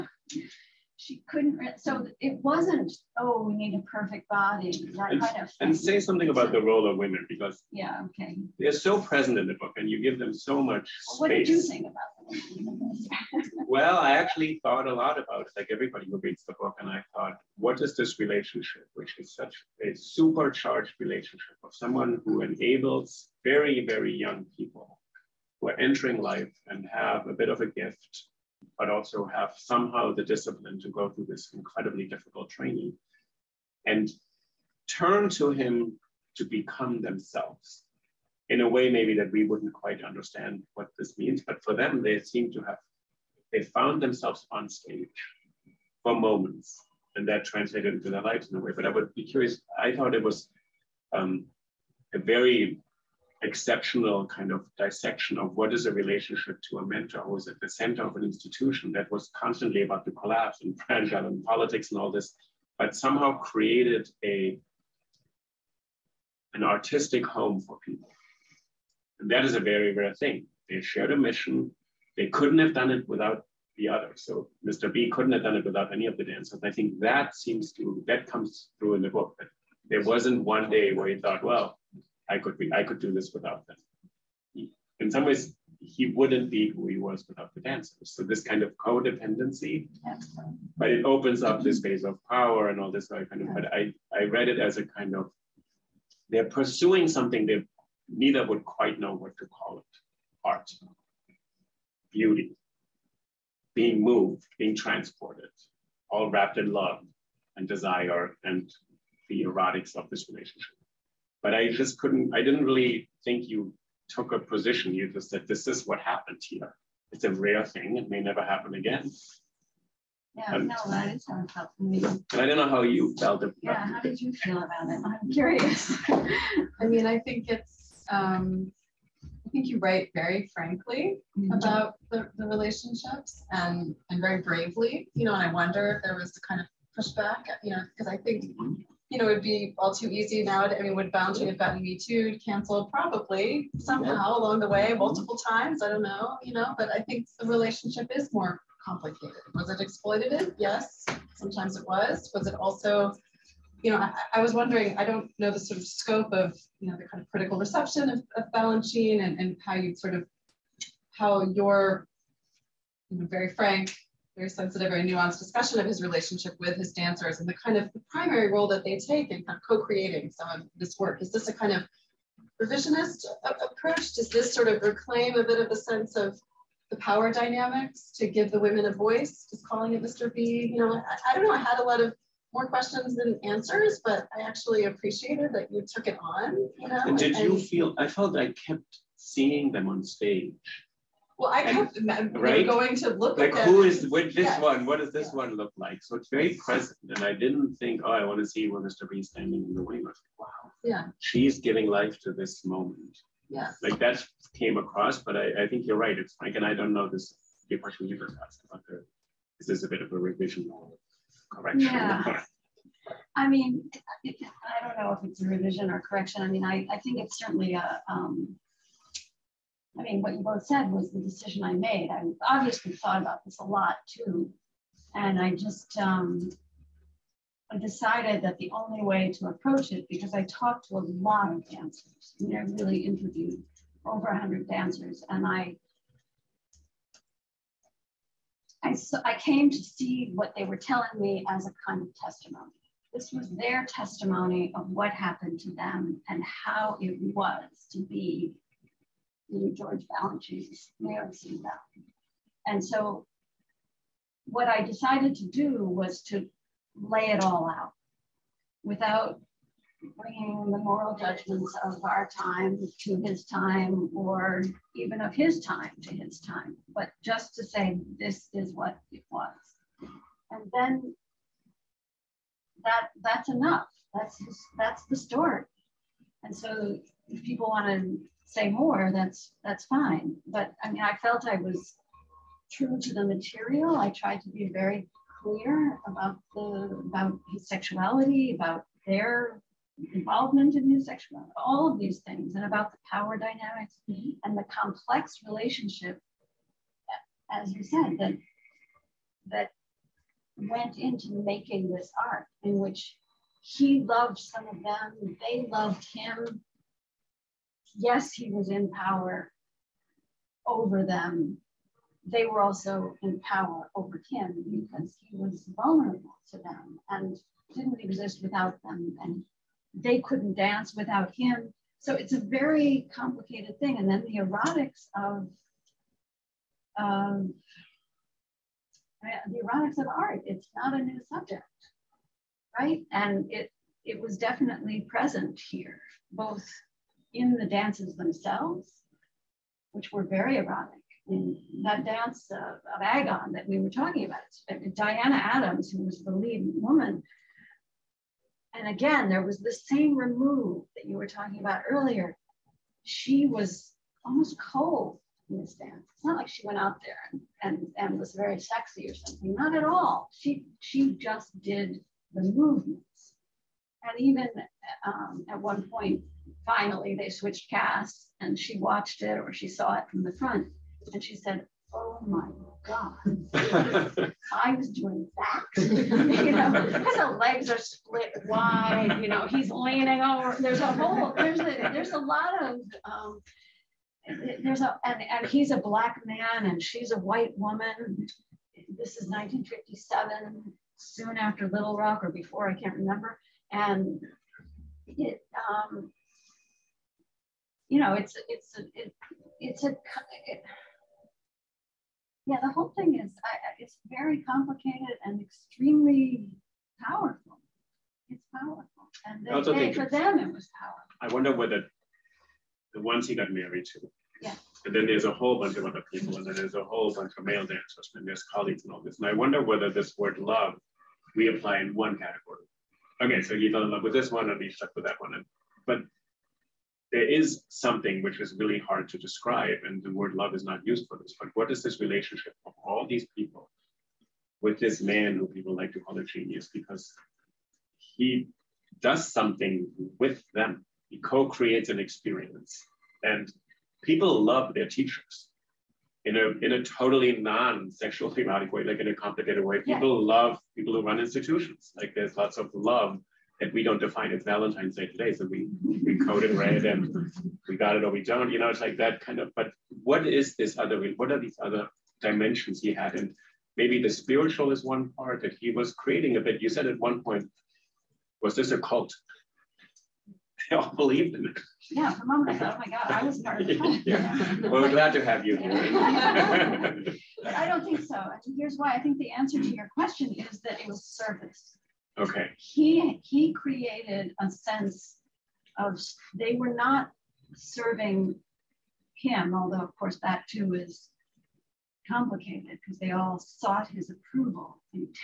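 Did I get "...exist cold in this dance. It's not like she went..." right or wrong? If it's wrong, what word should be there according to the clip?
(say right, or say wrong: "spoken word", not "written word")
wrong: "almost", not "exist".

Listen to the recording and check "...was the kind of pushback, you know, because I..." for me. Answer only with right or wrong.
right.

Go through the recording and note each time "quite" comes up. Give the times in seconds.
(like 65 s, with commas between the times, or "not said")
39 s, 98 s.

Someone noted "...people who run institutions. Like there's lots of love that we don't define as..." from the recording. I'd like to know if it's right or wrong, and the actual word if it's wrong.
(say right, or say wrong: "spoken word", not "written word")
right.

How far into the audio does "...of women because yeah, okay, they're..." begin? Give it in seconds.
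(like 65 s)
6 s.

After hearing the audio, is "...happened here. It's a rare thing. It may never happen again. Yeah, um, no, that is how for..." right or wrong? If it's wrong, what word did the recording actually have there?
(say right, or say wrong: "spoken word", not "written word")
right.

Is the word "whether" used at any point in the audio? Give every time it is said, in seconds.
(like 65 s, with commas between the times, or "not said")
411 s, 419 s.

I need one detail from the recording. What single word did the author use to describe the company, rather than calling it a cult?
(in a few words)
service.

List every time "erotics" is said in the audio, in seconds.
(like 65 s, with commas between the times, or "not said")
109 s, 324 s, 329 s, 340 s.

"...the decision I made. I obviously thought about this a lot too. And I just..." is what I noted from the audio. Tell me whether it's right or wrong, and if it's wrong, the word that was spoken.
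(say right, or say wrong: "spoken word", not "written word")
right.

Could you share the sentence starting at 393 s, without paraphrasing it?
And it, um, you know, it's it's it, it's a it, yeah.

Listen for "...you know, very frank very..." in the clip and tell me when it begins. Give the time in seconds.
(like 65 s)
163 s.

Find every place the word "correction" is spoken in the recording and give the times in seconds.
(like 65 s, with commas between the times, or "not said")
211 s, 215 s.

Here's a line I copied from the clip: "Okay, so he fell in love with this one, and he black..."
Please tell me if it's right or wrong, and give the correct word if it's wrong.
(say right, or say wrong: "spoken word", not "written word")
wrong: "stuck", not "black".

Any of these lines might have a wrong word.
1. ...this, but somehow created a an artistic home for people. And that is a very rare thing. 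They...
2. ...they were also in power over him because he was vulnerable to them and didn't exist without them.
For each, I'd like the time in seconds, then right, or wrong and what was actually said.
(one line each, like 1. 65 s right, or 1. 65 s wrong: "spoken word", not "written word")
1. 62 s right
2. 312 s right.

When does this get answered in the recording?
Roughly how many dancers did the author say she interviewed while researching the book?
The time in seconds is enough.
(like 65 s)
234 s.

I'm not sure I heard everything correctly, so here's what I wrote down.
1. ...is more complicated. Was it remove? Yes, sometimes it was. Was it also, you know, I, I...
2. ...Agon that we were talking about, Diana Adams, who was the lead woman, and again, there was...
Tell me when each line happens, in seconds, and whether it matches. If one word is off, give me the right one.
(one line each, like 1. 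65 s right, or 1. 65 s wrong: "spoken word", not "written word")
1. 148 s wrong: "exploitative", not "remove"
2. 343 s right.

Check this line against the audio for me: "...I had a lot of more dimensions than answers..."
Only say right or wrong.
wrong.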